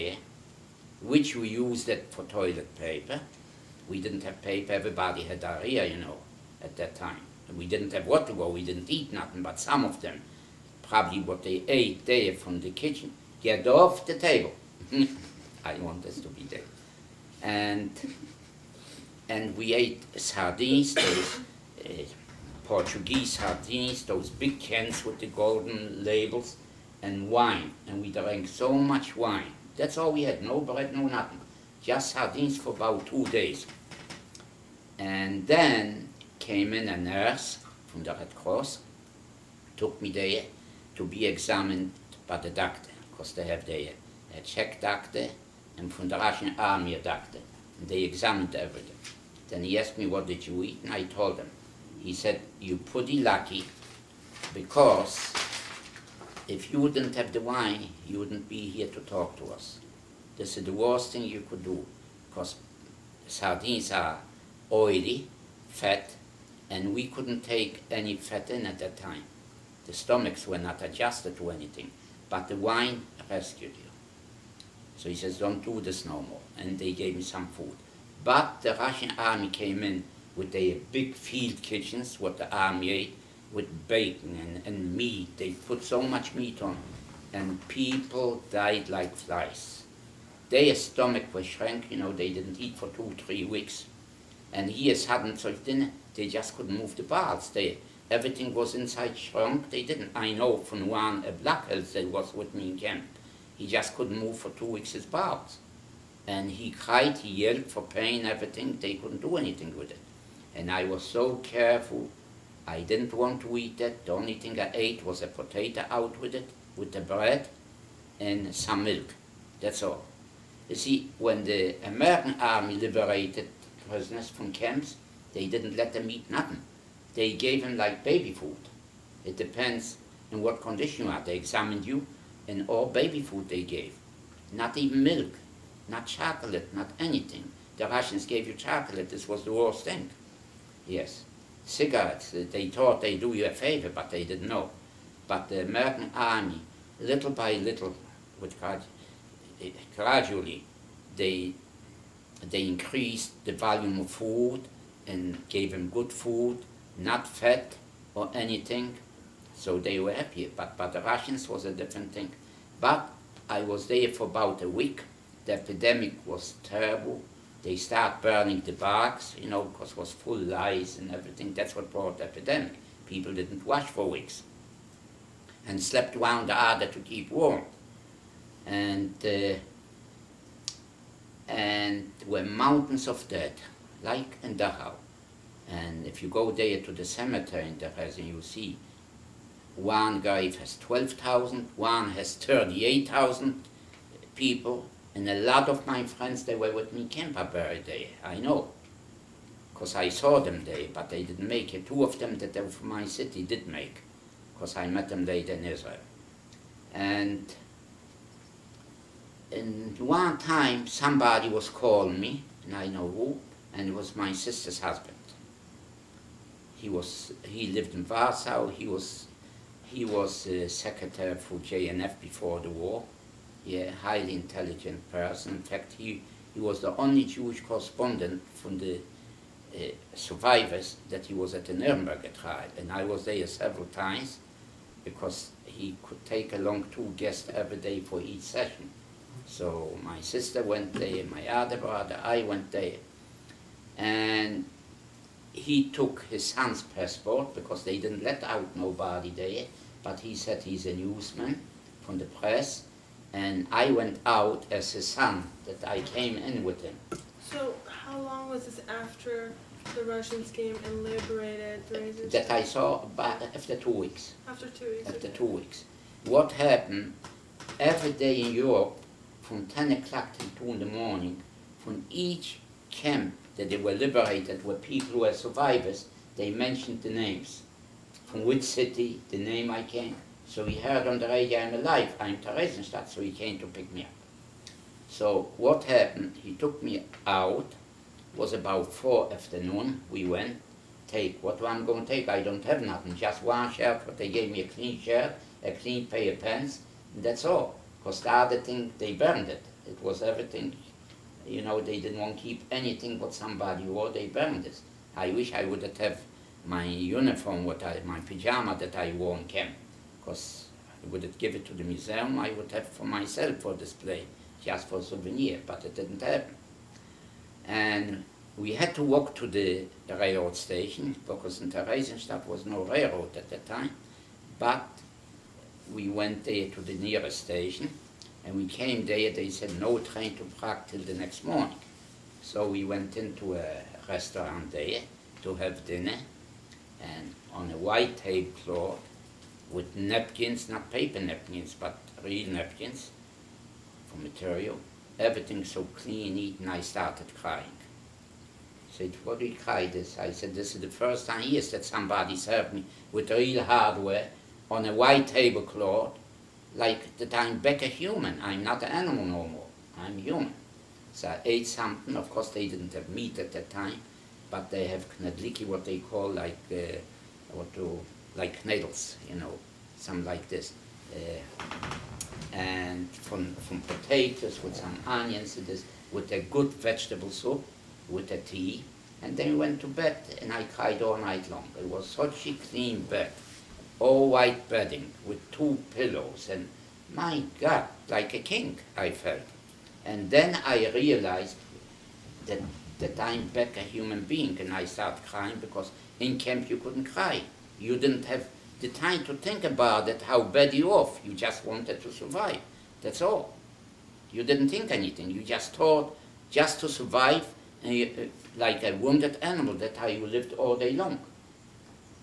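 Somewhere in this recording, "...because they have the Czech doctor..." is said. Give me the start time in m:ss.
0:43.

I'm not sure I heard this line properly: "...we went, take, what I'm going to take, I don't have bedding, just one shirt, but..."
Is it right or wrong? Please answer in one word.
wrong.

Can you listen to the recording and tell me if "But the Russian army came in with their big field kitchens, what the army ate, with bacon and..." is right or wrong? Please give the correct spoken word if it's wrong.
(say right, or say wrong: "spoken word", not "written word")
right.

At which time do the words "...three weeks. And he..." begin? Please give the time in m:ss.
1:33.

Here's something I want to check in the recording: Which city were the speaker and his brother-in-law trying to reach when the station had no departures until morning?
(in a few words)
Prague.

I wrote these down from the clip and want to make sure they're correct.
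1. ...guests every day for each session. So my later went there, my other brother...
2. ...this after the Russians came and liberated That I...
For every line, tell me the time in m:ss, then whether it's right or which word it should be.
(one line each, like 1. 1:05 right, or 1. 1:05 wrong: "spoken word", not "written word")
1. 3:57 wrong: "sister", not "later"
2. 4:18 right.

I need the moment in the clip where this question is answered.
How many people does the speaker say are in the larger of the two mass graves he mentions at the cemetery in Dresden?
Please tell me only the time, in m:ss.
3:12.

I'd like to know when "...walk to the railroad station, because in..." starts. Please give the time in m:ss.
5:19.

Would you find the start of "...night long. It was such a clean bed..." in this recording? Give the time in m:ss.
6:21.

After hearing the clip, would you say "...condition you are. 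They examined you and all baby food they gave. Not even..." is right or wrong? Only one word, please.
right.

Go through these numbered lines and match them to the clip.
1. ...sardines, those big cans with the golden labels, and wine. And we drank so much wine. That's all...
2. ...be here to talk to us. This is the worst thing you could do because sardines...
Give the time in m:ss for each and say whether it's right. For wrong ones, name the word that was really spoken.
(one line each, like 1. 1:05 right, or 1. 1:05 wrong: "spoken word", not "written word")
1. 0:23 right
2. 0:58 right.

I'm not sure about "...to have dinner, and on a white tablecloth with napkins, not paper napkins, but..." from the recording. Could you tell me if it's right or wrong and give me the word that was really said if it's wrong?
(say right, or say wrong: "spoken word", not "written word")
right.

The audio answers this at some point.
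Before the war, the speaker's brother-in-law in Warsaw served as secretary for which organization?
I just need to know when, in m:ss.
3:41.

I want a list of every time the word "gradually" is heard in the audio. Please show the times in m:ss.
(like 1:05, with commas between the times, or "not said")
2:29.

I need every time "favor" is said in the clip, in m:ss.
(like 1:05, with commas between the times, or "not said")
2:23.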